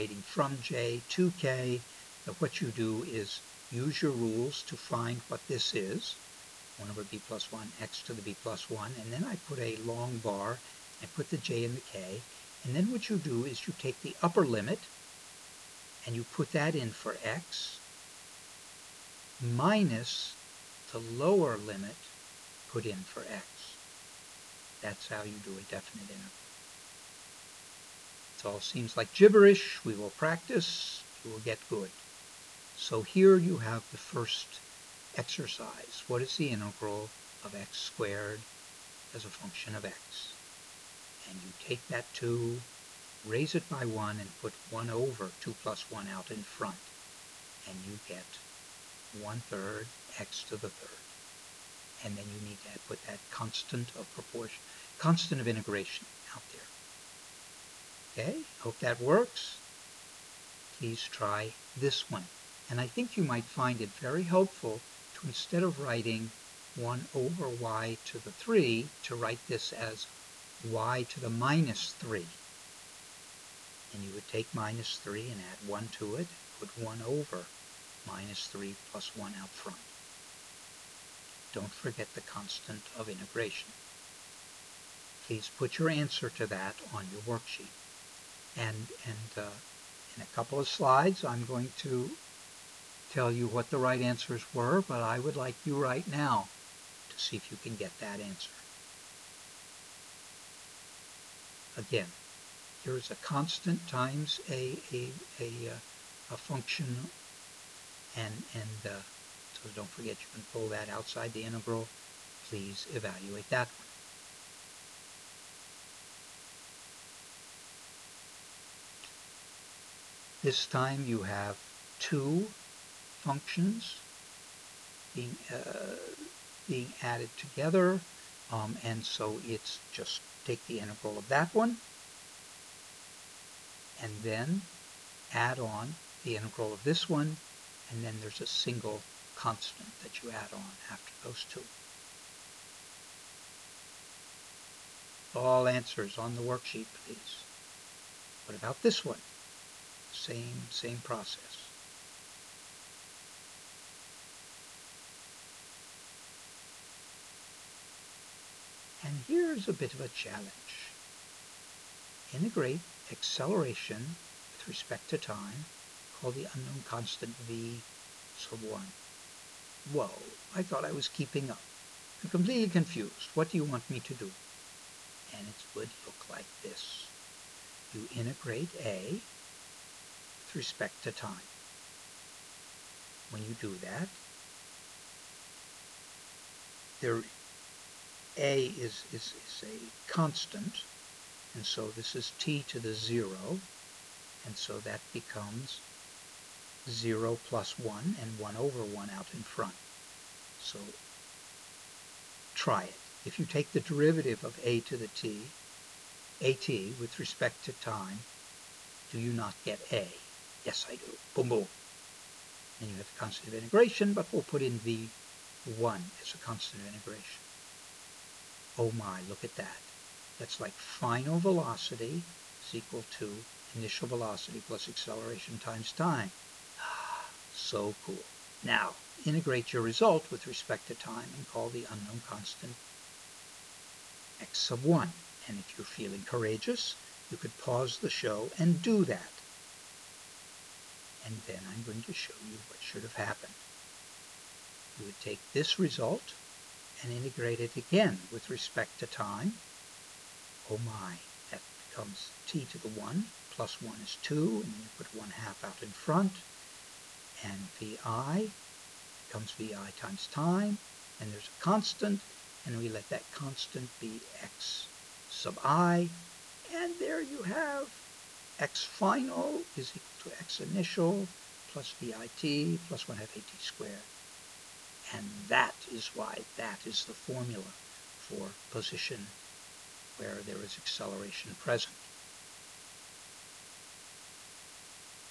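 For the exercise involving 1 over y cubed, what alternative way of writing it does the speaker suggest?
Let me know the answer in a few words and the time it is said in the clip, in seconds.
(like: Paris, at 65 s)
y to the minus 3, at 70 s.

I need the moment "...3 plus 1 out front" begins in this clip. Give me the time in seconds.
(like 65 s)
78 s.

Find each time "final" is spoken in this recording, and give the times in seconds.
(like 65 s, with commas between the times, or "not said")
220 s, 268 s.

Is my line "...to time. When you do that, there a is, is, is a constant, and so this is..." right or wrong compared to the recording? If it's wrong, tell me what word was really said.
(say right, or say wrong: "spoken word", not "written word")
right.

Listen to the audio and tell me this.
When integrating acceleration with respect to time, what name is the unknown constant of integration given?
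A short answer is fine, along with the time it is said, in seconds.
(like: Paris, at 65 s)
v sub 1, at 167 s.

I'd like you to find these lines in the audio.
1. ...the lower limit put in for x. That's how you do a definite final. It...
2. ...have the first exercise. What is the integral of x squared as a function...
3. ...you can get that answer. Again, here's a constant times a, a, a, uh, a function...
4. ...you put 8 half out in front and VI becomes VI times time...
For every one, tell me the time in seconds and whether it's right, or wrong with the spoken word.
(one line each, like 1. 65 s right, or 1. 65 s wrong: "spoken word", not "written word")
1. 20 s wrong: "integral", not "final"
2. 33 s right
3. 97 s right
4. 254 s wrong: "1", not "8".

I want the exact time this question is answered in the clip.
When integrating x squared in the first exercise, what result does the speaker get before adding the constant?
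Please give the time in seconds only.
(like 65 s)
49 s.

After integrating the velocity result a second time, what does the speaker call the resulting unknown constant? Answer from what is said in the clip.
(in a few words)
x sub 1.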